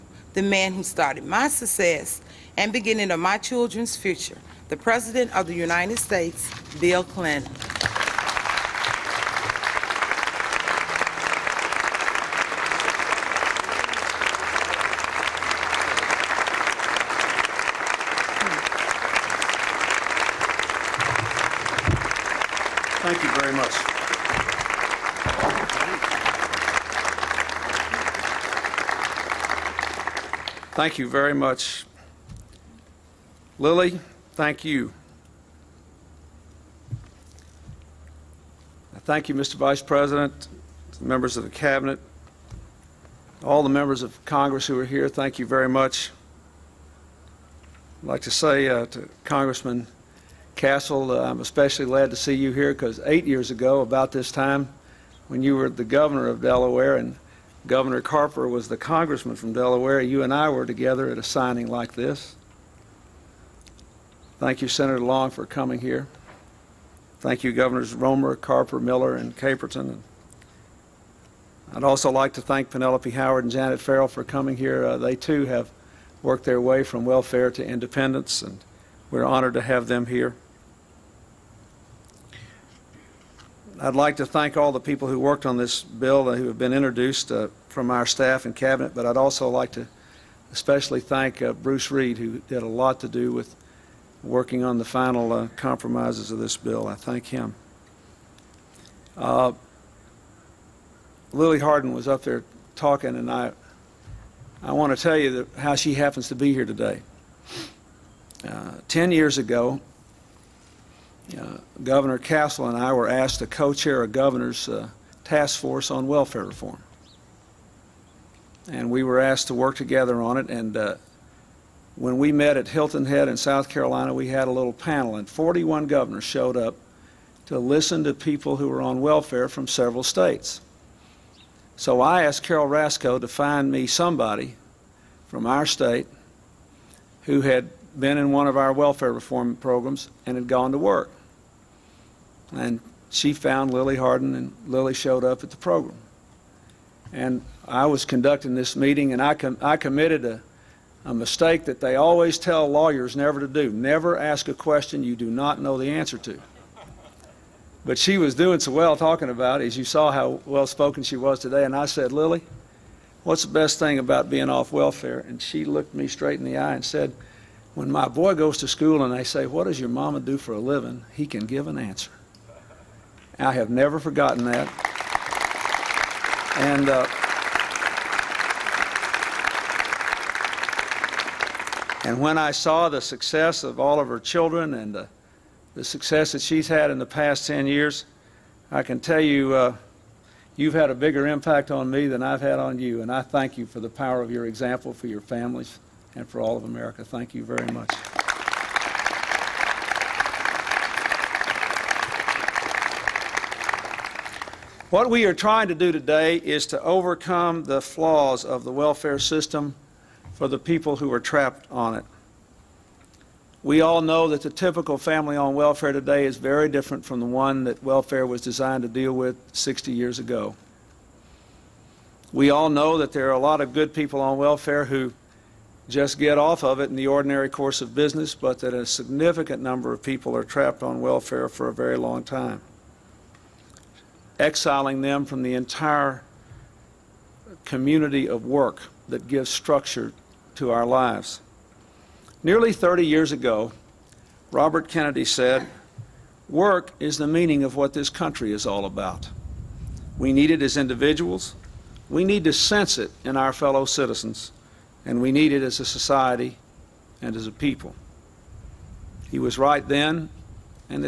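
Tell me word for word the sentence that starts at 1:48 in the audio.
Uh, ten years ago, uh, Governor Castle and I were asked to co-chair a governor's uh, task force on welfare reform.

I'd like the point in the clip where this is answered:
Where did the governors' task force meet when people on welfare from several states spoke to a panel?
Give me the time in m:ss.
2:02.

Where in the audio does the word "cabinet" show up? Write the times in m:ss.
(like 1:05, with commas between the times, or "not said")
0:41, 1:28.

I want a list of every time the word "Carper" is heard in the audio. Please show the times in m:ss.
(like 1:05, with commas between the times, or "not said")
0:58, 1:08.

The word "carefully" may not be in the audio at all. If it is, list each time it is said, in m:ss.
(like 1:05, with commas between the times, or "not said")
not said.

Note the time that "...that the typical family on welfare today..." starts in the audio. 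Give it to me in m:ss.
3:34.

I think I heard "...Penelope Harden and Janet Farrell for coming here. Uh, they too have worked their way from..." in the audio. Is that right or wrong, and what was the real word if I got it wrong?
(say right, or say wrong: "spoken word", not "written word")
wrong: "Howard", not "Harden".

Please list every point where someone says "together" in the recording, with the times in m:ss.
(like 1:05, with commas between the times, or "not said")
1:00, 1:59.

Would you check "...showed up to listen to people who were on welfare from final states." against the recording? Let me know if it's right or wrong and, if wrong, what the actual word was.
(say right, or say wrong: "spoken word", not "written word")
wrong: "several", not "final".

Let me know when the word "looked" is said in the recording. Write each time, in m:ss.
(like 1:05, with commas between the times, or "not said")
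2:45.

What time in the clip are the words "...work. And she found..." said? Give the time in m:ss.
2:20.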